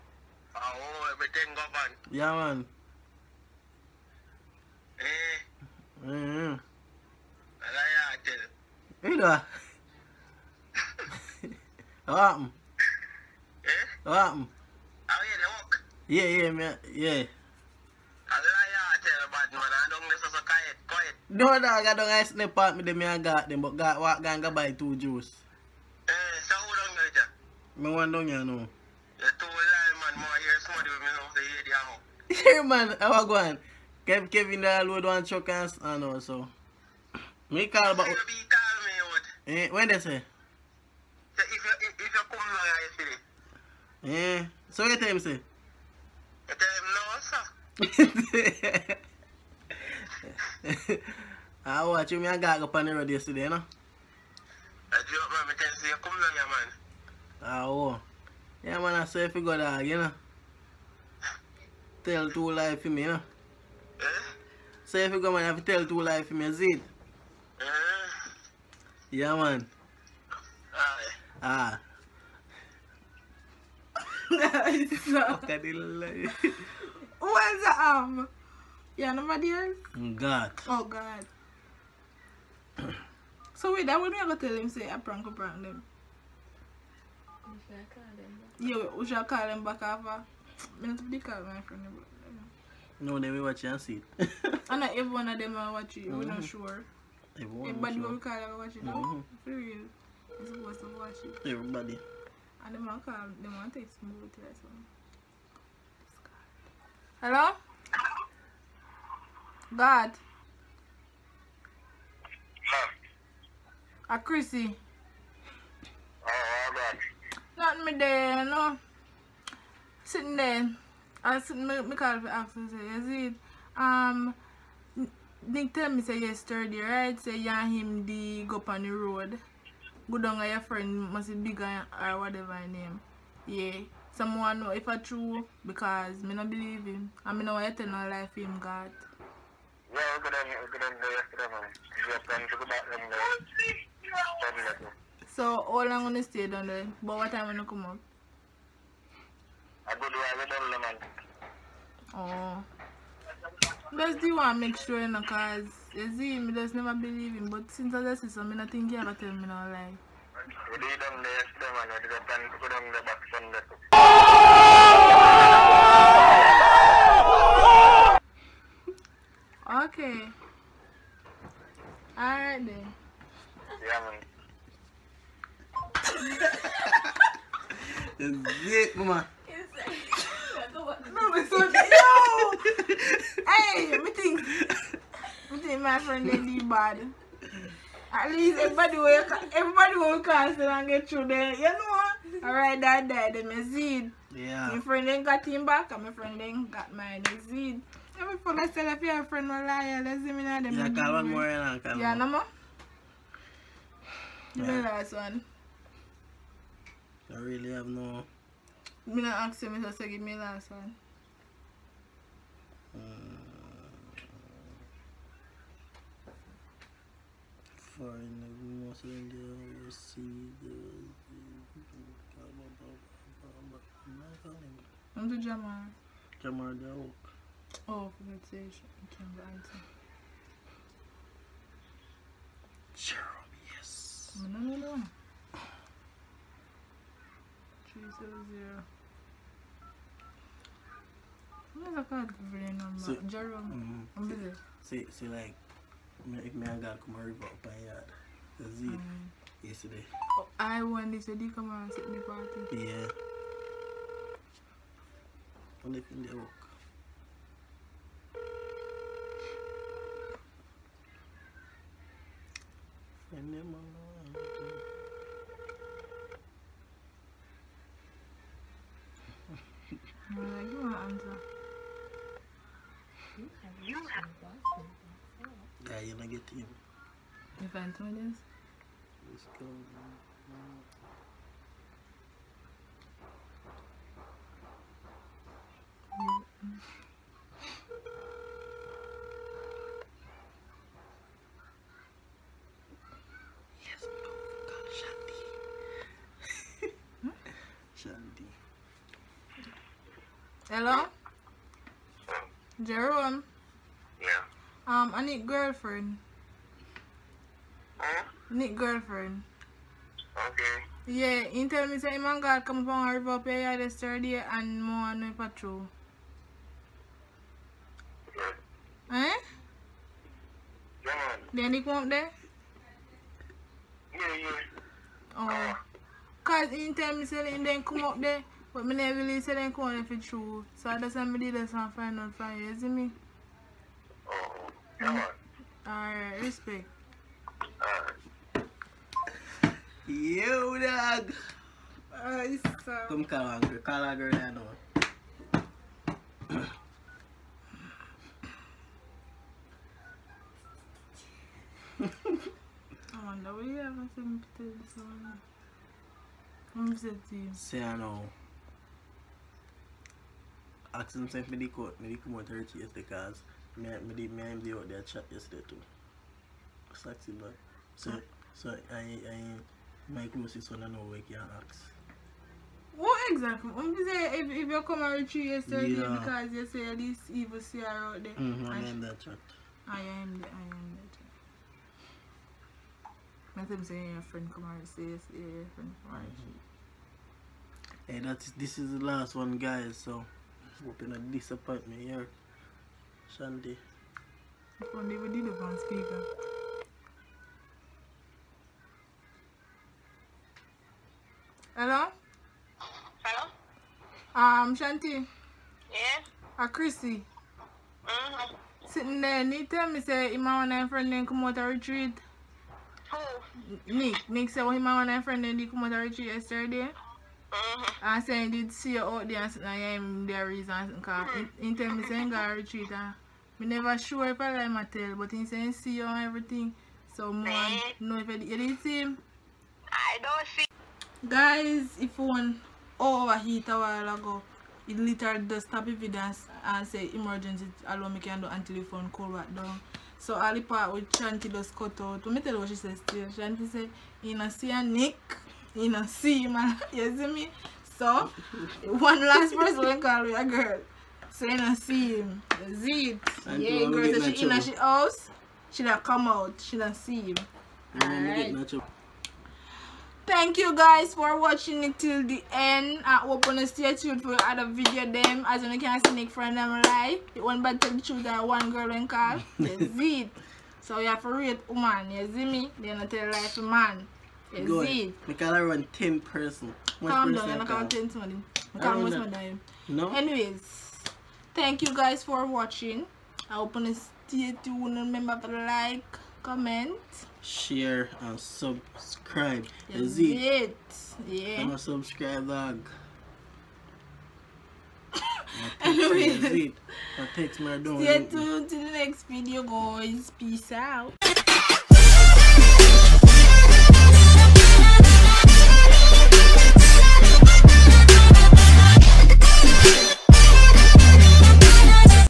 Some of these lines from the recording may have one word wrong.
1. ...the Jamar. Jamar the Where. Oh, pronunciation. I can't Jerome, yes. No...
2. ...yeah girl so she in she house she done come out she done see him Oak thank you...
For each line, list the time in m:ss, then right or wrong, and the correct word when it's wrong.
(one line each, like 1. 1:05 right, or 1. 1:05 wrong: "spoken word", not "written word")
1. 3:45 wrong: "Oak", not "Where"
2. 7:33 wrong: "Alright", not "Oak".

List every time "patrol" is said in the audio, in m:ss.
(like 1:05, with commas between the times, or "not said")
5:15.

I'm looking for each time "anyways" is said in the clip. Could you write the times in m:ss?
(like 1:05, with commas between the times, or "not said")
8:00, 8:15.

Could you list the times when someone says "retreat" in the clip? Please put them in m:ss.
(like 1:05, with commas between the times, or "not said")
6:51, 6:55, 7:02.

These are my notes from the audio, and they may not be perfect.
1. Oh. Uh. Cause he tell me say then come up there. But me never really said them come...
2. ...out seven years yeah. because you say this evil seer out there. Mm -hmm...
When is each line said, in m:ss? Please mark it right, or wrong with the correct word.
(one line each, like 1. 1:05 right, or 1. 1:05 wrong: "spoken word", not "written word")
1. 5:25 right
2. 6:15 wrong: "three", not "seven".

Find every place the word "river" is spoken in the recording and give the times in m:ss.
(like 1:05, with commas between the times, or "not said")
4:07, 5:13.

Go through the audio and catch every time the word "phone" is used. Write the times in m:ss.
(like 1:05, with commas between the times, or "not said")
3:18, 7:18.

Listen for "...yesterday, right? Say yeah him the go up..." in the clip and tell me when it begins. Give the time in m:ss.
2:06.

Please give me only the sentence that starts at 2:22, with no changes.
I'm good on So how long gonna stay down there?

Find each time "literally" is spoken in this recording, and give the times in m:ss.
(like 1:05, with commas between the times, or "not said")
7:14.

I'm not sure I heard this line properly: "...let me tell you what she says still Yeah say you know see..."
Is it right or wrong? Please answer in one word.
wrong.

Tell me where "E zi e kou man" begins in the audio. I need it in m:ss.
2:58.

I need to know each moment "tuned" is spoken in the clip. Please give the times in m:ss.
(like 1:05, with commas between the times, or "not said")
7:43, 8:04, 8:18.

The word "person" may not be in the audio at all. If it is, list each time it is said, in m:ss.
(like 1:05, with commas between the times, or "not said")
7:29, 7:56.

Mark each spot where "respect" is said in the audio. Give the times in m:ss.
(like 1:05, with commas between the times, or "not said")
5:36.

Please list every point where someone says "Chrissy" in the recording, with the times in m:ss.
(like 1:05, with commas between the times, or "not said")
1:54, 6:46.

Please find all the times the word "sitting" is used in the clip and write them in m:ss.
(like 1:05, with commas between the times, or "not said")
2:00, 6:48, 6:59.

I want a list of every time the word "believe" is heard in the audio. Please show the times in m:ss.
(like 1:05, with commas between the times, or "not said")
2:16, 2:36.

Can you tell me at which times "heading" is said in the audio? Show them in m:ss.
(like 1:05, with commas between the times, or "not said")
not said.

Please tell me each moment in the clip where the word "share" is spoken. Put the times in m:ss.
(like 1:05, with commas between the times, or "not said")
8:07.